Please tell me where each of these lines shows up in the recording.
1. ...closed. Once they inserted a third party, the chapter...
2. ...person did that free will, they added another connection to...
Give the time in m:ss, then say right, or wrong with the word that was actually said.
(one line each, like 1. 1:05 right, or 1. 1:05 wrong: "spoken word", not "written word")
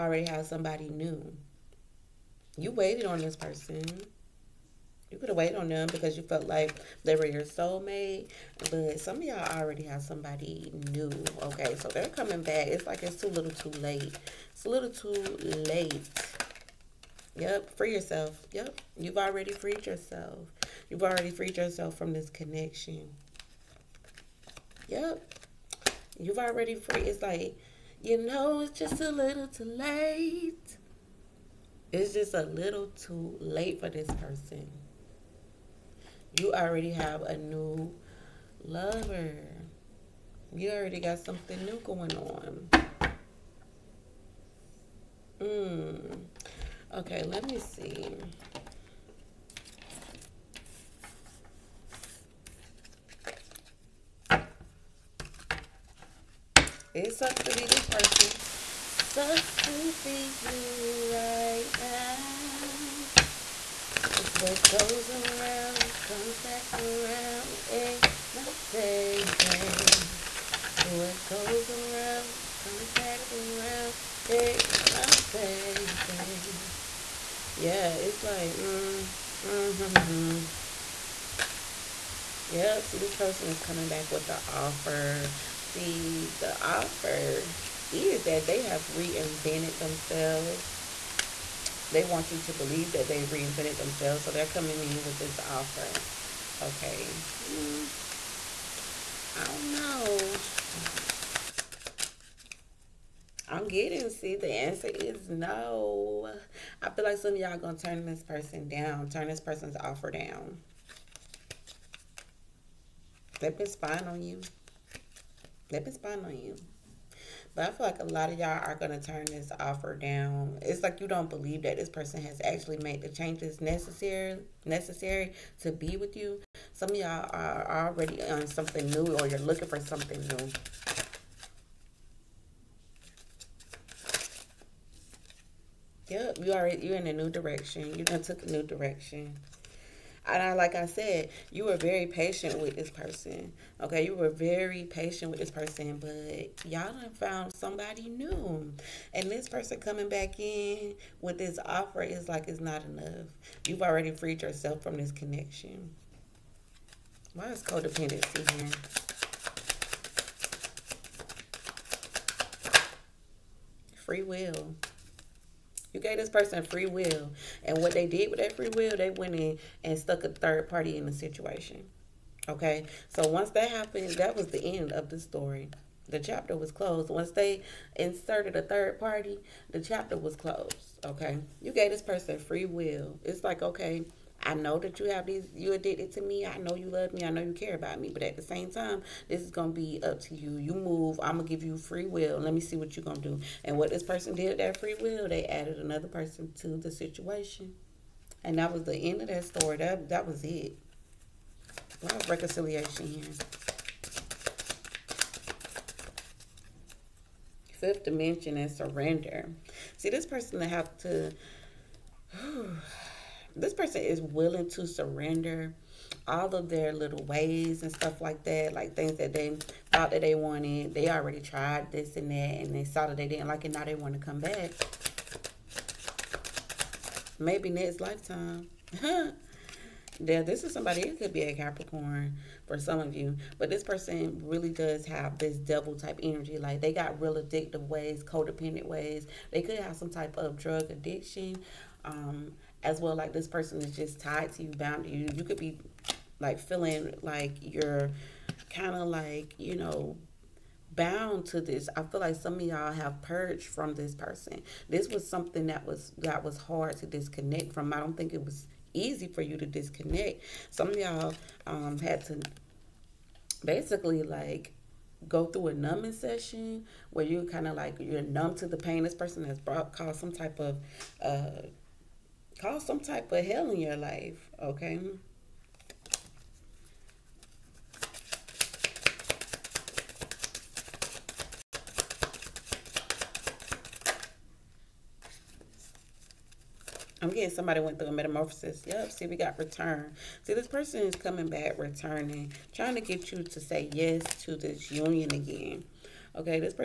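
1. 2:56 right
2. 3:14 wrong: "person", not "connection".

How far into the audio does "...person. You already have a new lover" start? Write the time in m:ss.
0:34.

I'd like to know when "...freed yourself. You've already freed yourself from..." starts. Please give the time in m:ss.
0:19.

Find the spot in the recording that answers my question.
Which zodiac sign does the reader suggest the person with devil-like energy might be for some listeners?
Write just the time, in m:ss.
3:51.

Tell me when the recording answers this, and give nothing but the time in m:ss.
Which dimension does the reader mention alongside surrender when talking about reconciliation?
3:27.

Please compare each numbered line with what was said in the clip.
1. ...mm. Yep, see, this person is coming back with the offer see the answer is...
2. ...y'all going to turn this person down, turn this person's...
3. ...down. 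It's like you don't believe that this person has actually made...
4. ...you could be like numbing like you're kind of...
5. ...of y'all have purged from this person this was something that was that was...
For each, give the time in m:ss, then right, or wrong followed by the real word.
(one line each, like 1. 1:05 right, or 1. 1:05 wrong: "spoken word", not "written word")
1. 1:19 wrong: "offer", not "answer"
2. 1:47 right
3. 1:59 right
4. 4:05 wrong: "feeling", not "numbing"
5. 4:12 right.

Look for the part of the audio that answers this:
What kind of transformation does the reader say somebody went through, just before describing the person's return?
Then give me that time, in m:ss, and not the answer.
4:48.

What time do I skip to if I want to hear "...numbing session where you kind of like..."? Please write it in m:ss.
4:25.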